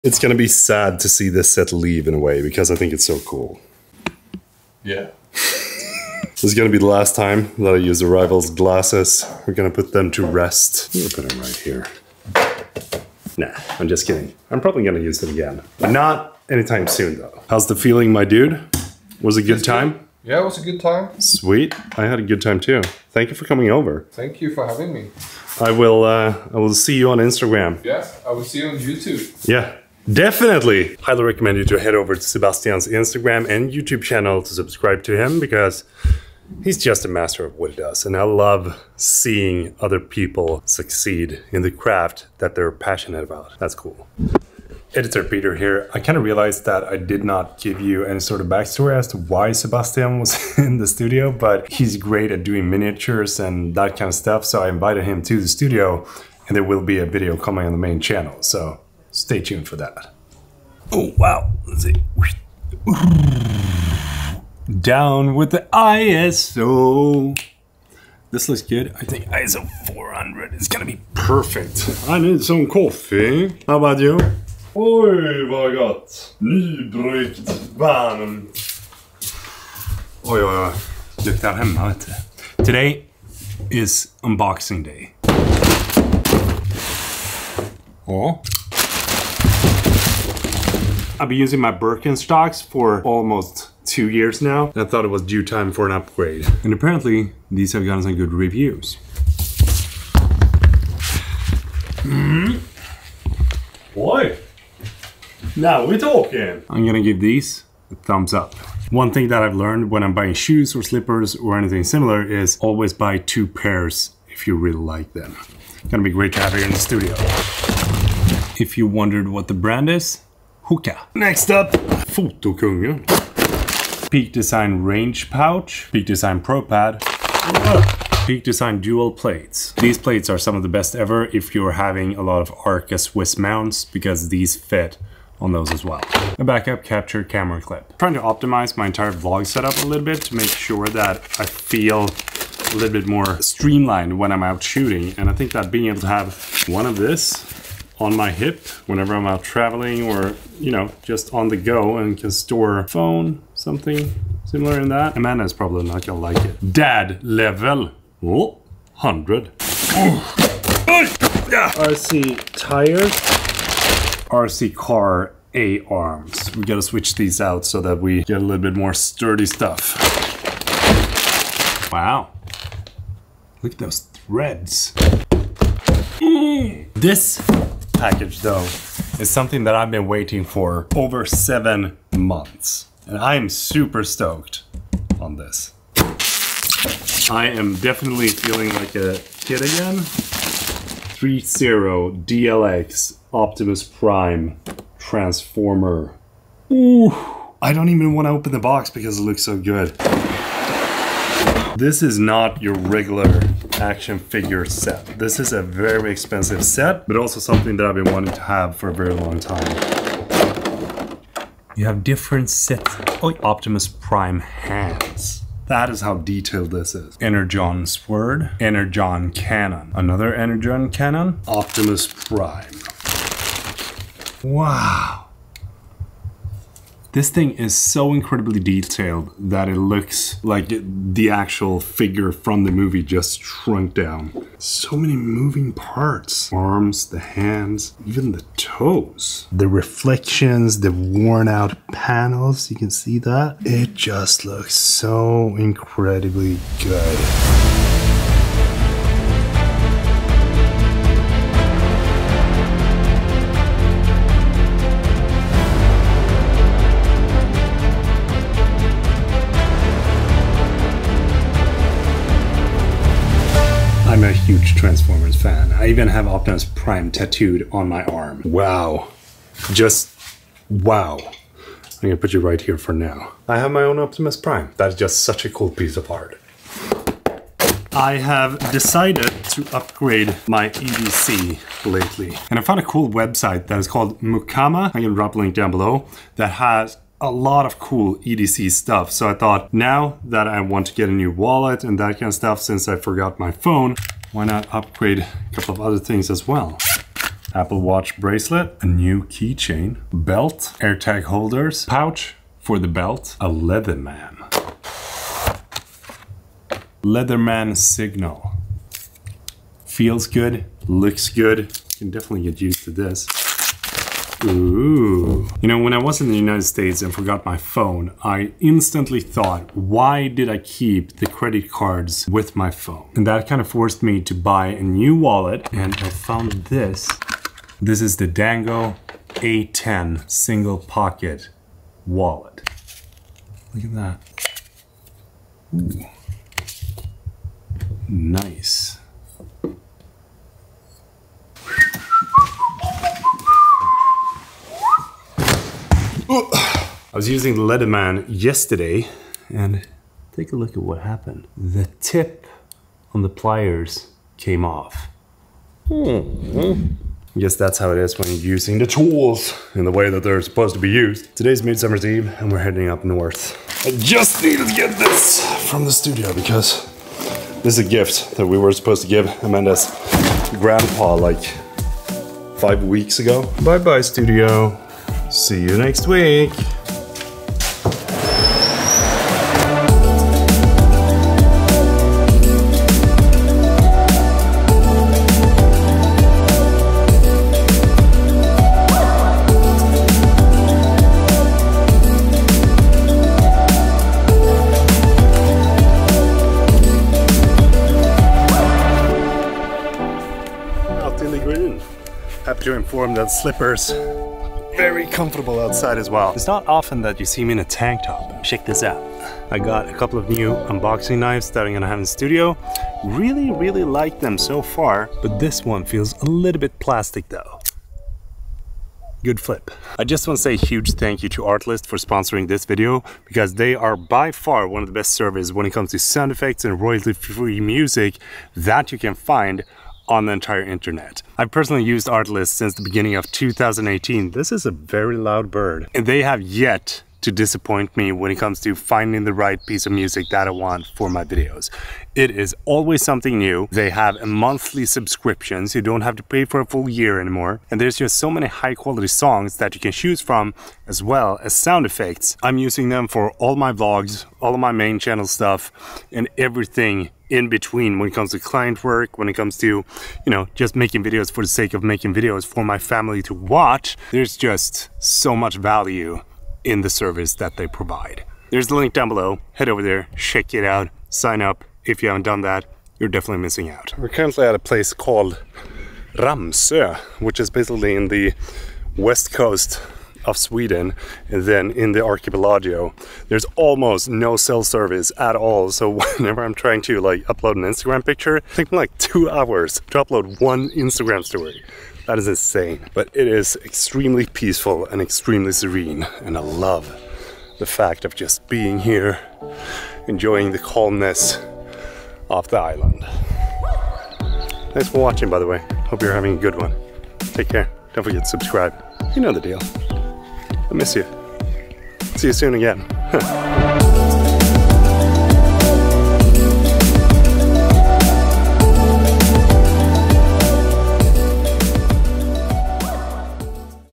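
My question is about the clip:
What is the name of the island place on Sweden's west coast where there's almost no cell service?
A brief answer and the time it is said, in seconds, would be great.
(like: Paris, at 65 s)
Ramsö, at 476 s.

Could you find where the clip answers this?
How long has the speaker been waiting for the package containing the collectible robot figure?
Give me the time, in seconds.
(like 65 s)
180 s.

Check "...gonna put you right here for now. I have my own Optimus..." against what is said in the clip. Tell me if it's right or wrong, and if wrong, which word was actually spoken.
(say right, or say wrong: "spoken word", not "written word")
right.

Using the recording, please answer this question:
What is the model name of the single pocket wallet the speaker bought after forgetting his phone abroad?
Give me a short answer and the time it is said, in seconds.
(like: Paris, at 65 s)
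Dango A10, at 328 s.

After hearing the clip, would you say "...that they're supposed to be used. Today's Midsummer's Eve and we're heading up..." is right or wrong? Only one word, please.
right.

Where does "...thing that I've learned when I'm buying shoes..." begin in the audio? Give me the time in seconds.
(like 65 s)
109 s.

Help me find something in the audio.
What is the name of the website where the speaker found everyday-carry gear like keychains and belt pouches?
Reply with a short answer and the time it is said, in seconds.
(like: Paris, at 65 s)
Mukama, at 284 s.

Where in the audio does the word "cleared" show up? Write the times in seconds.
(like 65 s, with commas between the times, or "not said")
not said.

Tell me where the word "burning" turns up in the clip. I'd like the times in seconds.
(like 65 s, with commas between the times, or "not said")
not said.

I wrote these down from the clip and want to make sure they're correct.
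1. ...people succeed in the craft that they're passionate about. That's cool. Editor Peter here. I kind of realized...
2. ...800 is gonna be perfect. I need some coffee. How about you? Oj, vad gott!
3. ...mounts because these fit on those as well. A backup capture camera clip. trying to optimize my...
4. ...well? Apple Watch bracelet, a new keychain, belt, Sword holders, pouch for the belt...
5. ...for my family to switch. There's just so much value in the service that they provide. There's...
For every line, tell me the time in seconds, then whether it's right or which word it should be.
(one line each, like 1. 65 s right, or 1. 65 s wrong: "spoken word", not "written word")
1. 40 s right
2. 69 s wrong: "400", not "800"
3. 133 s right
4. 296 s wrong: "AirTag", not "Sword"
5. 462 s wrong: "watch", not "switch".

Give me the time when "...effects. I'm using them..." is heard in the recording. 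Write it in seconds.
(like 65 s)
451 s.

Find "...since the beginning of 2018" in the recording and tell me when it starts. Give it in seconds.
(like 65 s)
432 s.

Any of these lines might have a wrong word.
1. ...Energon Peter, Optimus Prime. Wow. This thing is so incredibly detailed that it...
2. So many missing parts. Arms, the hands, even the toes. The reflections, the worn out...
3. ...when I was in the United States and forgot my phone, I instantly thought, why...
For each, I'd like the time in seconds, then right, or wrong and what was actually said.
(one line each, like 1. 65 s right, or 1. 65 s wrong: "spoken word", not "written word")
1. 220 s wrong: "Cannon", not "Peter"
2. 234 s wrong: "moving", not "missing"
3. 315 s right.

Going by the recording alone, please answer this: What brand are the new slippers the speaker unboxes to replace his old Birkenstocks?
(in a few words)
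Hoka.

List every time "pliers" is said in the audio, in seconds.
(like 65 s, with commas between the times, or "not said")
353 s.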